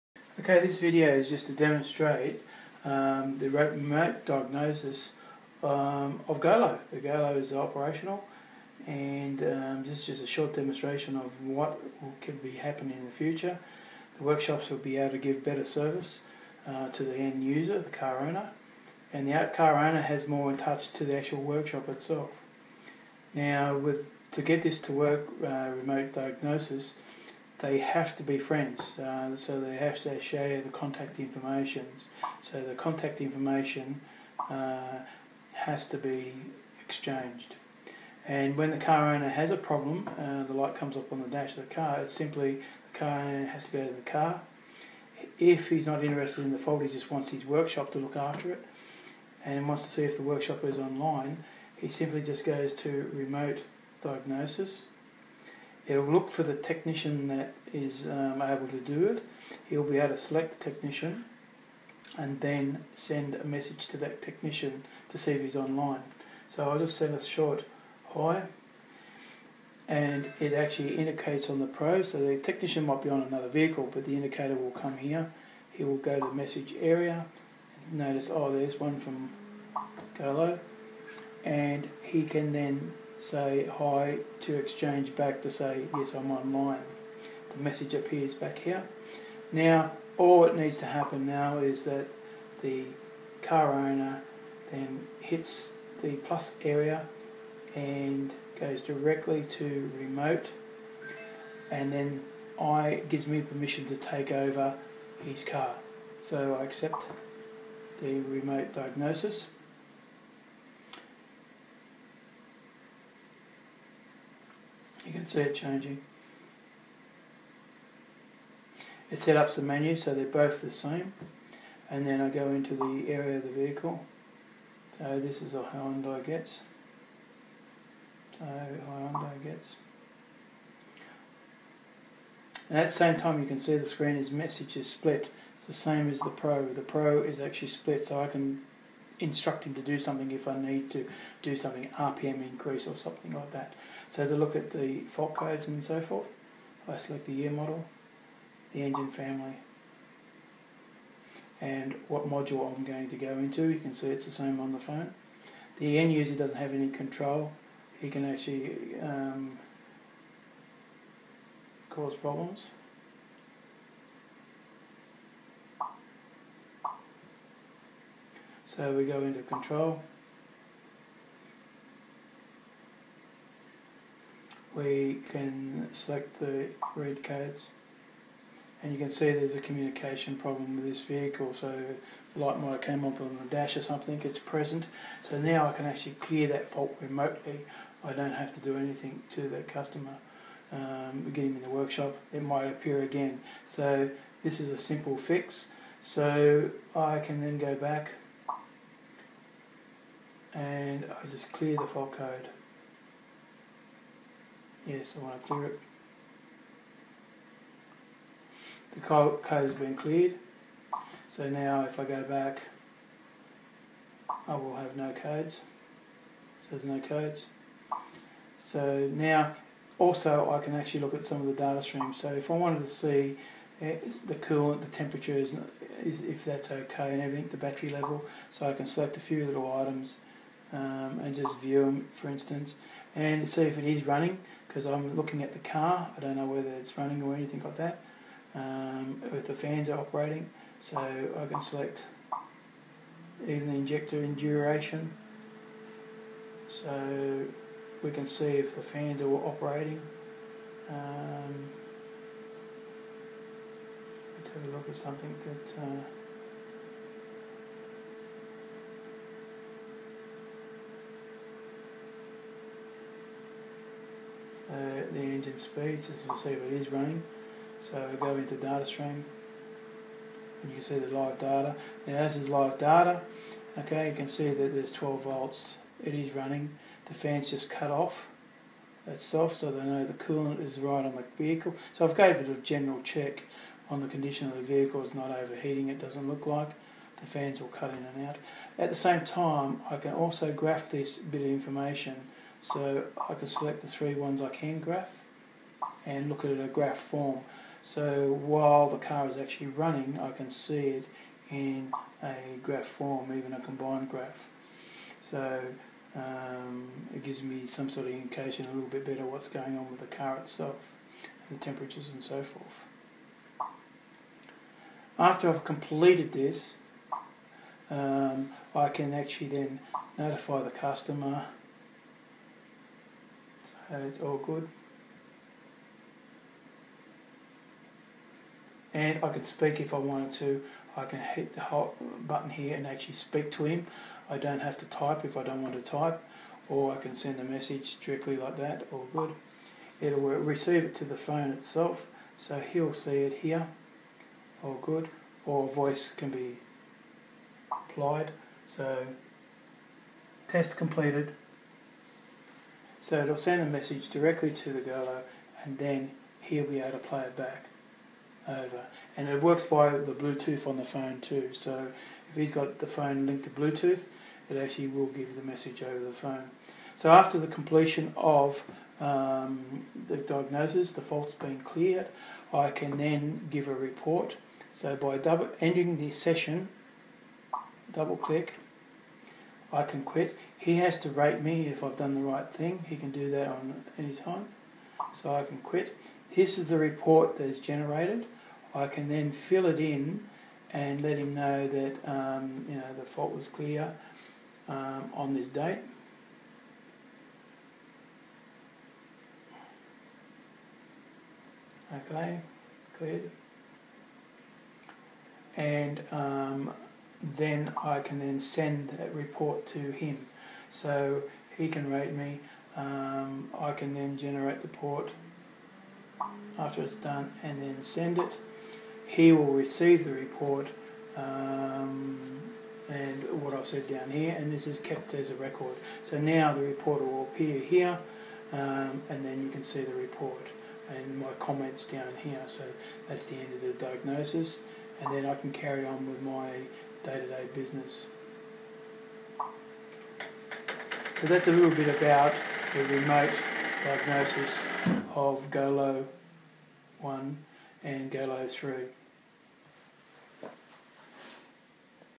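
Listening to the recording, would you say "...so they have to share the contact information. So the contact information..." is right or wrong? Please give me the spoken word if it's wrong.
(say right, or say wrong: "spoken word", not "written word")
right.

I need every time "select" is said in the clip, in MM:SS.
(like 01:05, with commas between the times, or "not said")
01:00, 02:26, 02:55, 03:48, 04:01, 04:53.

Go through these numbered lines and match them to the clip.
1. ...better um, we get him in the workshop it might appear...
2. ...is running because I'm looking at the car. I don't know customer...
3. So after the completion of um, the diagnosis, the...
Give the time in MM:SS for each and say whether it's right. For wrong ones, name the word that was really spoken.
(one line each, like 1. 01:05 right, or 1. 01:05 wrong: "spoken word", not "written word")
1. 03:09 wrong: "customer", not "better"
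2. 03:53 wrong: "whether", not "customer"
3. 06:06 right.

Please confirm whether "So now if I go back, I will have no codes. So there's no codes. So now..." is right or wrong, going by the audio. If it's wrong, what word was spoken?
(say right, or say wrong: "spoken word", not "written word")
right.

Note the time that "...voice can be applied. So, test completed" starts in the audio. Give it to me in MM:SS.
05:45.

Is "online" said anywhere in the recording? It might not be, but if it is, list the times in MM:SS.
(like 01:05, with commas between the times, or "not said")
00:50, 01:05, 01:26.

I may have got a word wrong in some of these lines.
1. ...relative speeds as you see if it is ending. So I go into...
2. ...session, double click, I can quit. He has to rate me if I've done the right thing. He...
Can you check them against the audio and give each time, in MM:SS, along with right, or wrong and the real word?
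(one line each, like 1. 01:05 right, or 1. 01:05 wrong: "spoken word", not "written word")
1. 04:25 wrong: "running", not "ending"
2. 06:16 right.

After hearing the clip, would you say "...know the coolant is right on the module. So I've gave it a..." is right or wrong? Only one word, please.
wrong.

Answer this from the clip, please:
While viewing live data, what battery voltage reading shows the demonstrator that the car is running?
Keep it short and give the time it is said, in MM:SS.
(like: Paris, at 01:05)
12 volts, at 04:34.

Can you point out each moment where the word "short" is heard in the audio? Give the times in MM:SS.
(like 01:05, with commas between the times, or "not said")
00:10, 01:07.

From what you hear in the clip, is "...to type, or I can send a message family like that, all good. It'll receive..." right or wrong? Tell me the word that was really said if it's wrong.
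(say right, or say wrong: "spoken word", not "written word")
wrong: "directly", not "family".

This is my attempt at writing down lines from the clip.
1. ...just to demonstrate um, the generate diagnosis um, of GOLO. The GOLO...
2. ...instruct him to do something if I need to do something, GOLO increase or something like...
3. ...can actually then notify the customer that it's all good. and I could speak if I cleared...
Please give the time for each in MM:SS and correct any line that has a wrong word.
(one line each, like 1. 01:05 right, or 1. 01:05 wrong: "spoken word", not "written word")
1. 00:01 wrong: "remote", not "generate"
2. 02:19 wrong: "RPM", not "GOLO"
3. 05:18 wrong: "wanted", not "cleared".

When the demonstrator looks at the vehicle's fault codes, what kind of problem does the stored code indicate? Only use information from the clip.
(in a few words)
Communication problem.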